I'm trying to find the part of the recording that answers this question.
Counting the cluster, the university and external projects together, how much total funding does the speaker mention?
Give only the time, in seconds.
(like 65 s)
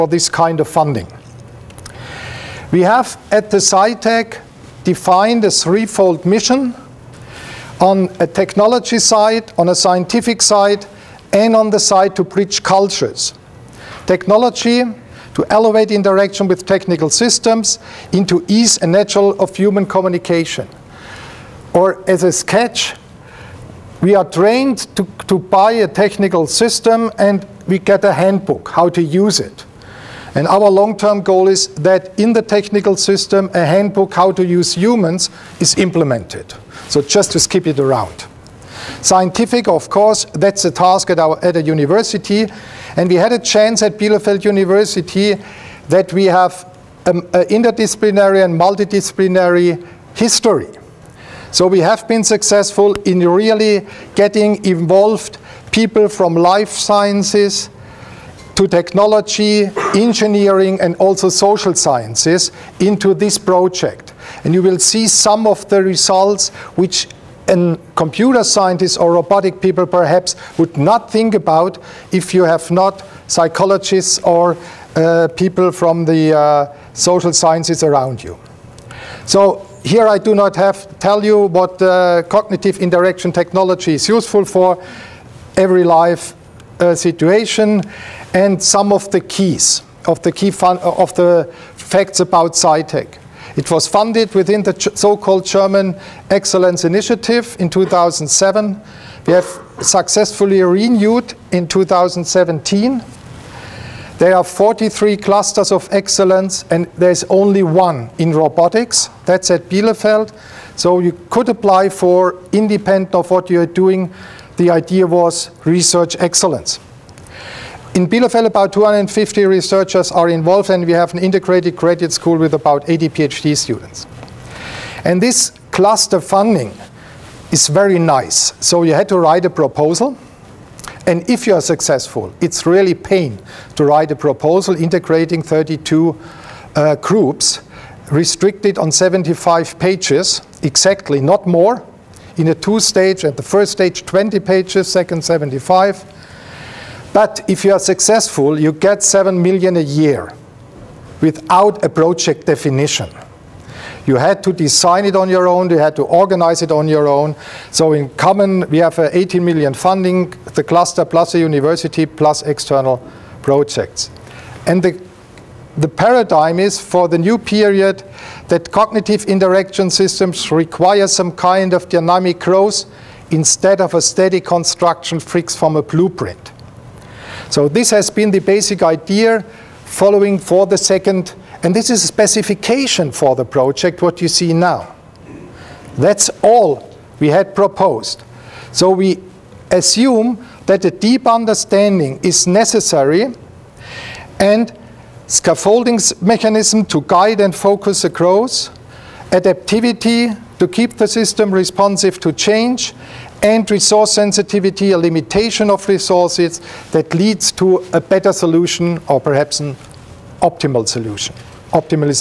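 158 s.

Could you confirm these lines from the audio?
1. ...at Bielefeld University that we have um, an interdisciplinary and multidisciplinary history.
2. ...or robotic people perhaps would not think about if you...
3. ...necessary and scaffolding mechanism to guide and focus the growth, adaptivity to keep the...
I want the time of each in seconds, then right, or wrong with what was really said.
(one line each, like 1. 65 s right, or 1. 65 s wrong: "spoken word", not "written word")
1. 43 s right
2. 68 s right
3. 192 s right.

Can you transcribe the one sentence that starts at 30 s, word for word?
And our long-term goal is that in the technical system, a handbook how to use humans is implemented.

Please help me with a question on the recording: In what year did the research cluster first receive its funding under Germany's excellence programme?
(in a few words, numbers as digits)
2007.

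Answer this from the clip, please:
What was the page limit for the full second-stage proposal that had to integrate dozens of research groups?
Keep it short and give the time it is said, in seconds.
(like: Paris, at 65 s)
75 pages, at 138 s.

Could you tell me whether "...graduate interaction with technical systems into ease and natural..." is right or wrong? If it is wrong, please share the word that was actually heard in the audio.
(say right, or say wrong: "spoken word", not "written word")
wrong: "elevate", not "graduate".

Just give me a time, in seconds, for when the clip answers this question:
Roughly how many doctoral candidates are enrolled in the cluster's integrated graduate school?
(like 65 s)
122 s.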